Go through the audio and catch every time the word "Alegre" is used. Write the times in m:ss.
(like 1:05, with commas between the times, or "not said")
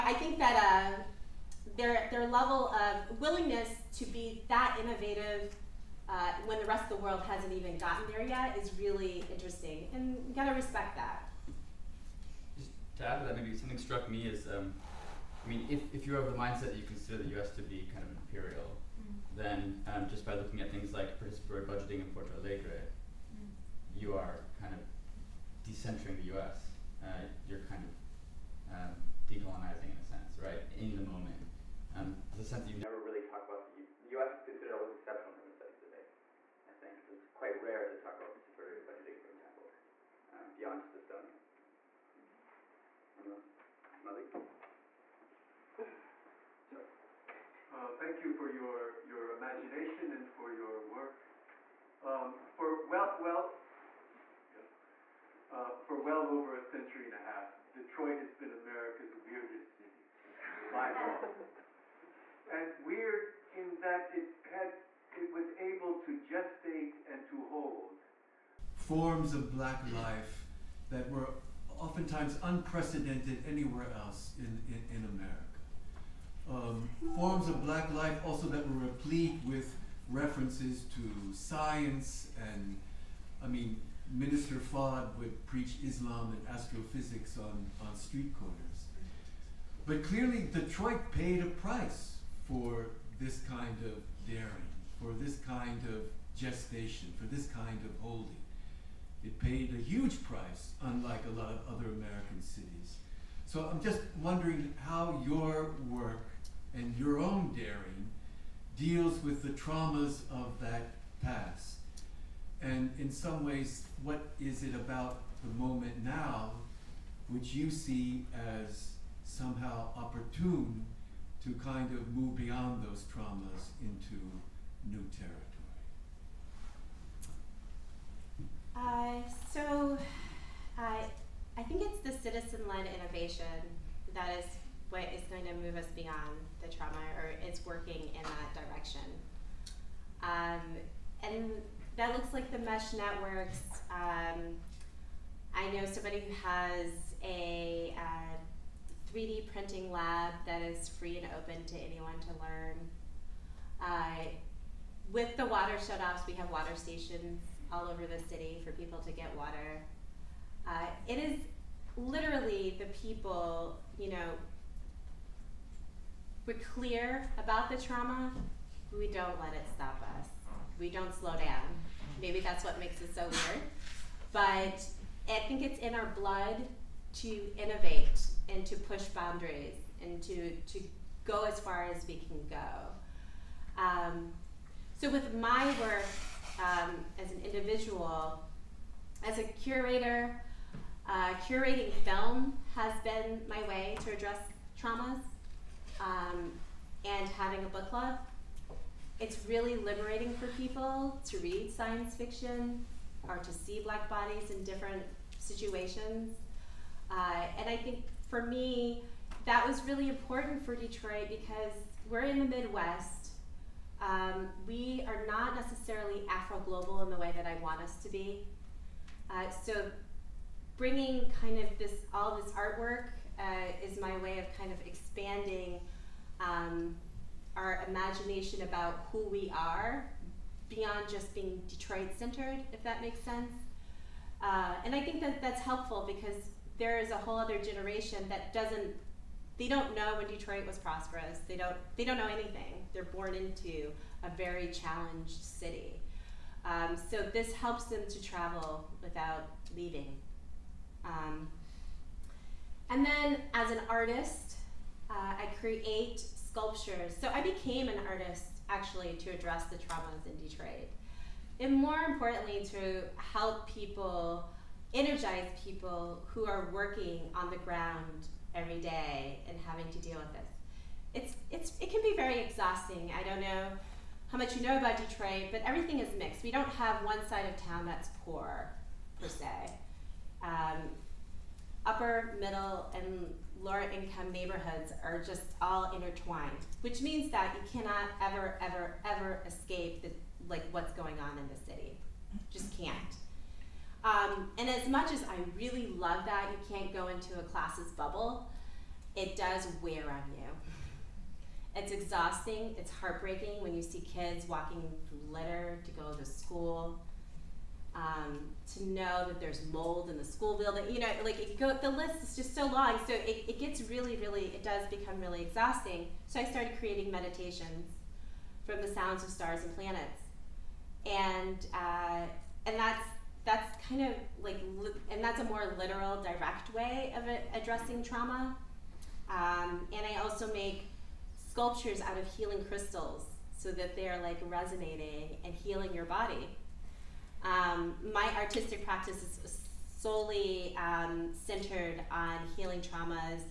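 0:22.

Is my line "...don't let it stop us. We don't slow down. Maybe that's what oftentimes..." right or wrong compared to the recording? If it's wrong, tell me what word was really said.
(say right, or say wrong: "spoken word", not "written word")
wrong: "makes", not "oftentimes".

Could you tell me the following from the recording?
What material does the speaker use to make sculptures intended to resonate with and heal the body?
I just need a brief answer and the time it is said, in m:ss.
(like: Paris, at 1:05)
healing crystals, at 5:32.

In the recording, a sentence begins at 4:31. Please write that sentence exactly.
It's, it's, it can be very exhausting.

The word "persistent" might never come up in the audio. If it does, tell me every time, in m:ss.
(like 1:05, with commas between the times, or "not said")
not said.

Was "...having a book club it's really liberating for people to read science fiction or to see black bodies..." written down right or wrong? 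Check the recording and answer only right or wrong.
right.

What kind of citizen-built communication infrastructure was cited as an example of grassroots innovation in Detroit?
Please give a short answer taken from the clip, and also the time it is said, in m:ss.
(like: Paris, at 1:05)
mesh networks, at 2:22.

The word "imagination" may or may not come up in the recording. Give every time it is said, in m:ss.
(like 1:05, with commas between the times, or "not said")
0:49, 3:47.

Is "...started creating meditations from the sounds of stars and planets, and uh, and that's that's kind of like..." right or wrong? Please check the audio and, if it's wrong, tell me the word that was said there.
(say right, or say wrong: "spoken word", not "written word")
right.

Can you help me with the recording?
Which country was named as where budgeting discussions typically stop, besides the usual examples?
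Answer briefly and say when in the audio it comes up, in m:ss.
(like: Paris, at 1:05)
Estonia, at 0:40.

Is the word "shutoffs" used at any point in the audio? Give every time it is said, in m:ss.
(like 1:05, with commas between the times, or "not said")
2:35.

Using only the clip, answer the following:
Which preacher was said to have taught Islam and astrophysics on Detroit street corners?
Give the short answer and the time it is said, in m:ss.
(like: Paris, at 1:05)
Minister Fard, at 1:24.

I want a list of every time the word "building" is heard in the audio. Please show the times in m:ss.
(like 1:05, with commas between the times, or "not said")
5:10.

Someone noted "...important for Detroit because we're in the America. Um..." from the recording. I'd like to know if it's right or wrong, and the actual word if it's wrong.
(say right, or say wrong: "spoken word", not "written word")
wrong: "Midwest", not "America".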